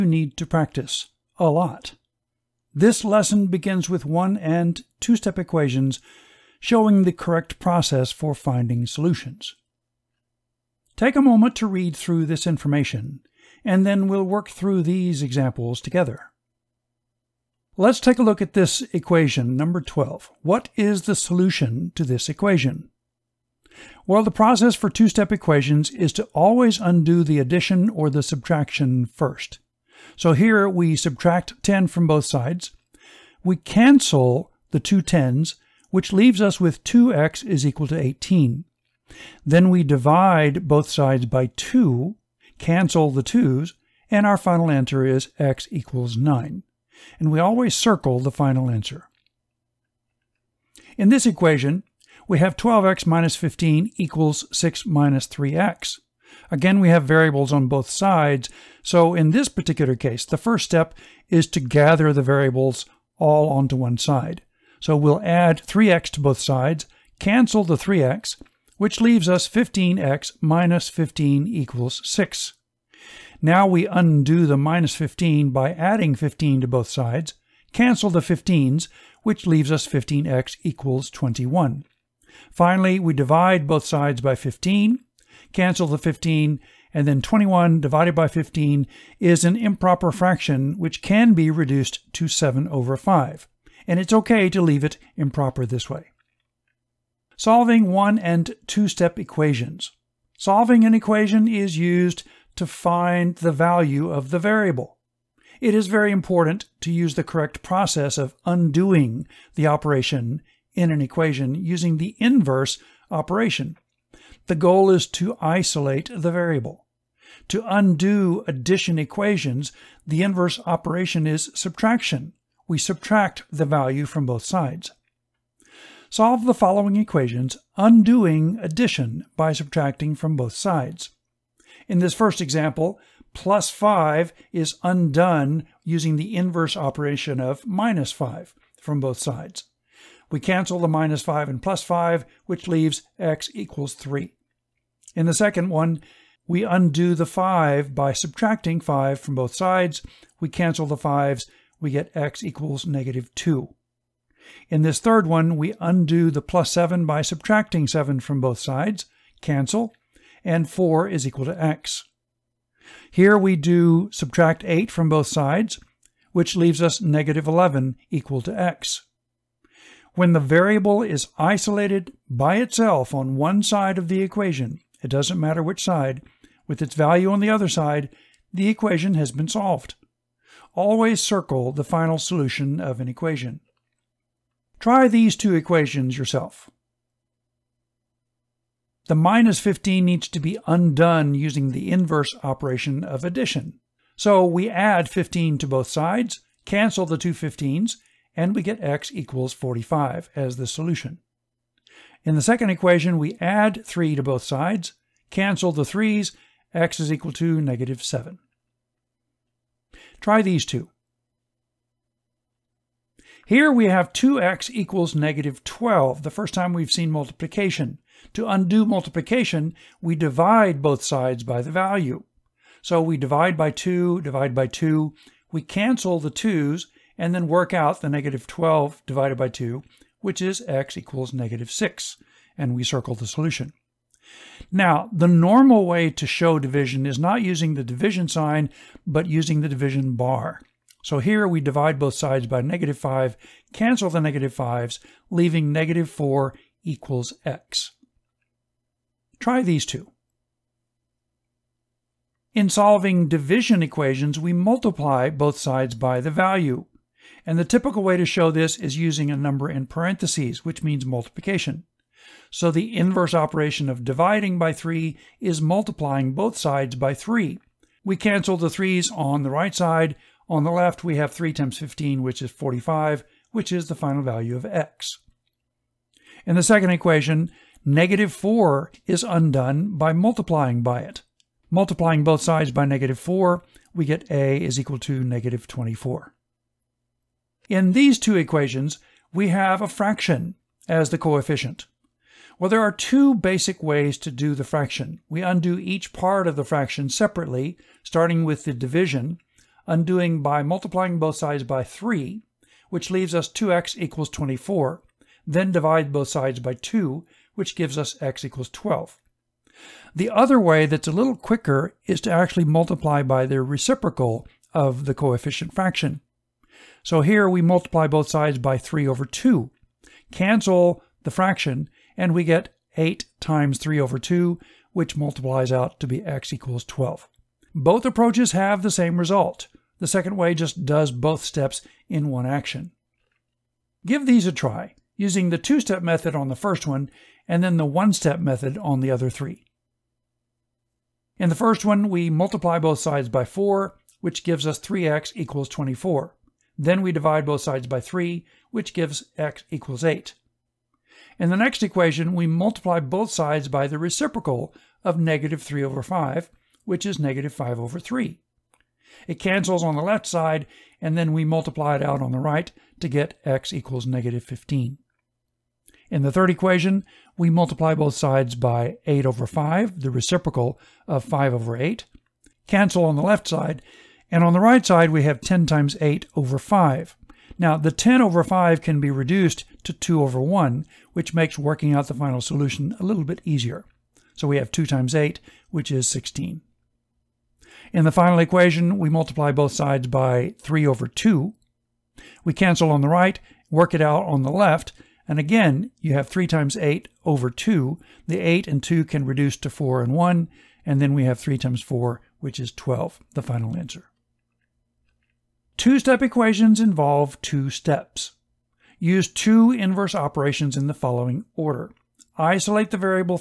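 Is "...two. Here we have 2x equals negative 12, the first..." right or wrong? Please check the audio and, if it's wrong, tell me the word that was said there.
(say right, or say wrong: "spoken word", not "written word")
right.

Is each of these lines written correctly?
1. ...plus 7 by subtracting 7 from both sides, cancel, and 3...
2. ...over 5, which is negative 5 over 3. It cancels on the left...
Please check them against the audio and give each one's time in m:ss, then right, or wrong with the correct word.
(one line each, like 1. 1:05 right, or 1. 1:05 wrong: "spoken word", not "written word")
1. 2:36 wrong: "4", not "3"
2. 5:55 right.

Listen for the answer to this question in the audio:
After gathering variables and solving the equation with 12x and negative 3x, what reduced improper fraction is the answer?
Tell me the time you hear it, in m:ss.
1:32.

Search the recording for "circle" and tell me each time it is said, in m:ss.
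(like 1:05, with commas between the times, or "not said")
0:47, 3:01, 3:52.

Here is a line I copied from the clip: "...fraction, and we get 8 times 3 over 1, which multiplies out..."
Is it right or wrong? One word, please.
wrong.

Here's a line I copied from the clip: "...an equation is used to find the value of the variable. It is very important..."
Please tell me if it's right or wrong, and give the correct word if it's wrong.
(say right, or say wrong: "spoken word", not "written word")
right.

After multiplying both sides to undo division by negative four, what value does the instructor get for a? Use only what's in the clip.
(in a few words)
-24.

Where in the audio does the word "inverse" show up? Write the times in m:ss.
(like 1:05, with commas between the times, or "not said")
1:52, 2:00, 2:16, 3:11, 4:22, 6:49.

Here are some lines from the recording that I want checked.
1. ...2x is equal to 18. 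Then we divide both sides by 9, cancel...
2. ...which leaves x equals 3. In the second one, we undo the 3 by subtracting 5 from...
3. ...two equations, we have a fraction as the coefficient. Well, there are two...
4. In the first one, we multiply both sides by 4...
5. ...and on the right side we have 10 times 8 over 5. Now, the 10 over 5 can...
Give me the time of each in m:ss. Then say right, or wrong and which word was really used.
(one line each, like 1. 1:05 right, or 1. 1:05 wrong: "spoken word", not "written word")
1. 0:36 wrong: "2", not "9"
2. 2:22 wrong: "5", not "3"
3. 4:48 right
4. 5:41 right
5. 6:14 right.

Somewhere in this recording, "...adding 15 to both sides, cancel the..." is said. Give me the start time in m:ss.
1:15.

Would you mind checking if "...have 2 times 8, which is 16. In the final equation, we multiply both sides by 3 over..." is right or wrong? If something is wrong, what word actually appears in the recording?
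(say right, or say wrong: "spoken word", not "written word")
right.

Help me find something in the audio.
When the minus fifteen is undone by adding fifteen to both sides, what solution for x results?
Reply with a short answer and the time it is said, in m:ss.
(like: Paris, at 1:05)
x = 45, at 3:18.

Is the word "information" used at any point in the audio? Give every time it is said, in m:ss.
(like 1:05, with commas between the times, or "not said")
0:12.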